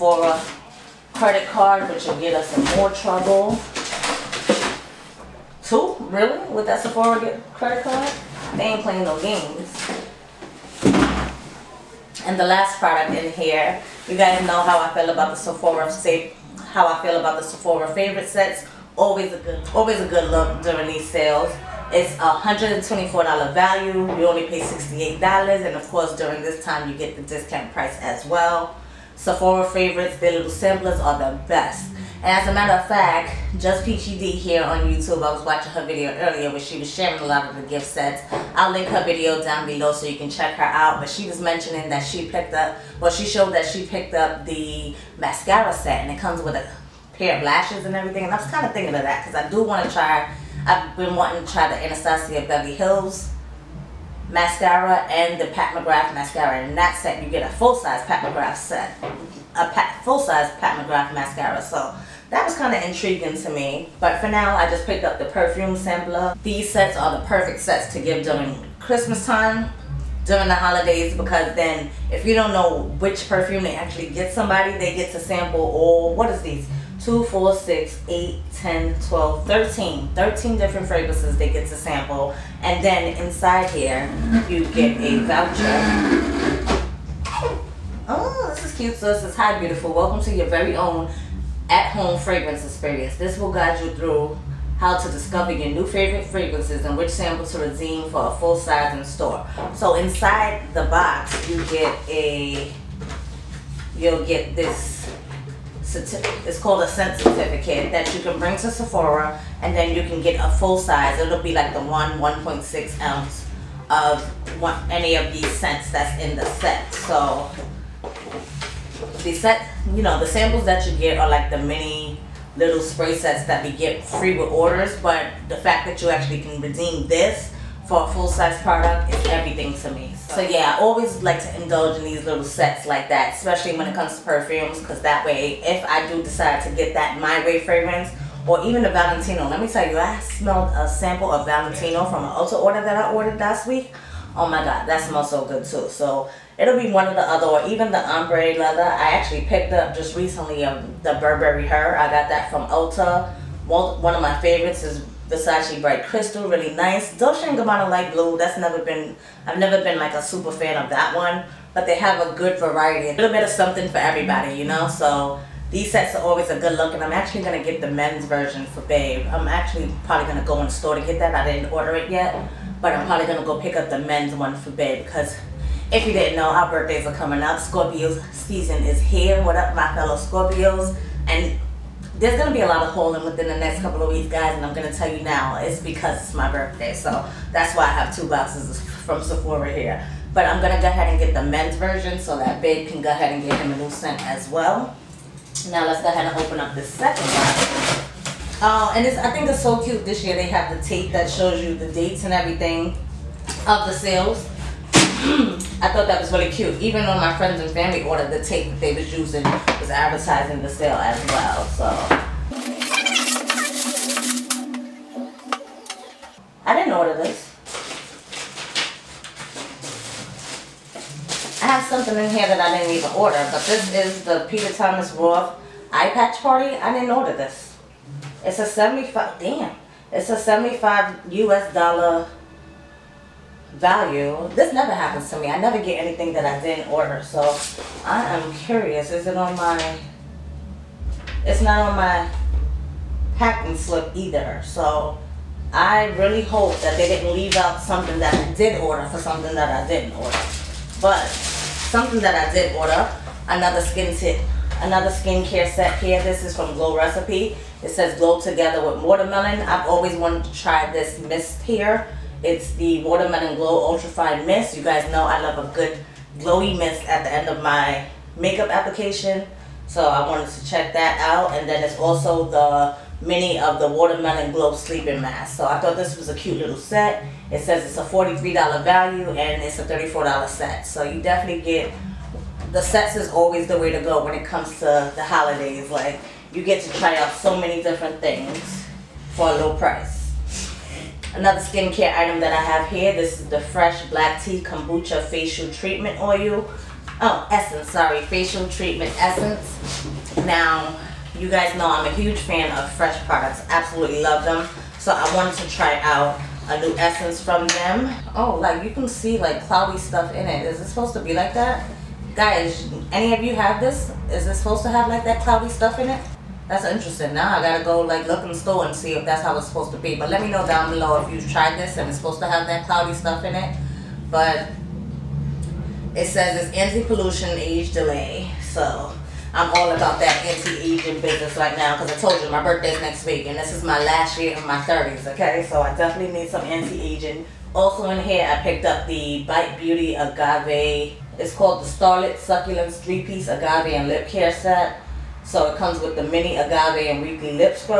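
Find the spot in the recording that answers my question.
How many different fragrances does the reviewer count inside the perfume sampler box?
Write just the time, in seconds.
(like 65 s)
80 s.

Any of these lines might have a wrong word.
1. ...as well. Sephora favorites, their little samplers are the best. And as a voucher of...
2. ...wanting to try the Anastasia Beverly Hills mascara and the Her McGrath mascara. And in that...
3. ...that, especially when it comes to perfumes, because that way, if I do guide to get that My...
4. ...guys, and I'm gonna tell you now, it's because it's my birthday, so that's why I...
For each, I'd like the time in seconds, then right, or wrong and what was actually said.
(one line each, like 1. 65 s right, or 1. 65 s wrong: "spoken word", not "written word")
1. 28 s wrong: "matter", not "voucher"
2. 51 s wrong: "Pat", not "Her"
3. 133 s wrong: "decide", not "guide"
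4. 184 s right.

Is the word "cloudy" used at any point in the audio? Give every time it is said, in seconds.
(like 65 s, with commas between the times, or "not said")
309 s, 315 s, 322 s.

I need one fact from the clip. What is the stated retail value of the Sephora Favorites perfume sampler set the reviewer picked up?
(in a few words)
$124.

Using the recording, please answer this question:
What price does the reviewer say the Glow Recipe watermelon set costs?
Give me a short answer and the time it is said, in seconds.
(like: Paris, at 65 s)
$34, at 279 s.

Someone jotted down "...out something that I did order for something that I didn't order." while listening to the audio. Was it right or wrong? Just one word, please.
right.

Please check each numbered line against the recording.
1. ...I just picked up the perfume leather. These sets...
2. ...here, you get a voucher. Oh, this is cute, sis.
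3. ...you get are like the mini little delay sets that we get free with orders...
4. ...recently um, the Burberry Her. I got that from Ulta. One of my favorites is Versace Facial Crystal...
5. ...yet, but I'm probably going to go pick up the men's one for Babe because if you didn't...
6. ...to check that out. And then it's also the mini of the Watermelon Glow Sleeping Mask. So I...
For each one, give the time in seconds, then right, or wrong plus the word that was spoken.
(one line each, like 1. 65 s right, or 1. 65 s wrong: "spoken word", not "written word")
1. 64 s wrong: "sampler", not "leather"
2. 83 s right
3. 120 s wrong: "spray", not "delay"
4. 150 s wrong: "Bright", not "Facial"
5. 172 s right
6. 270 s right.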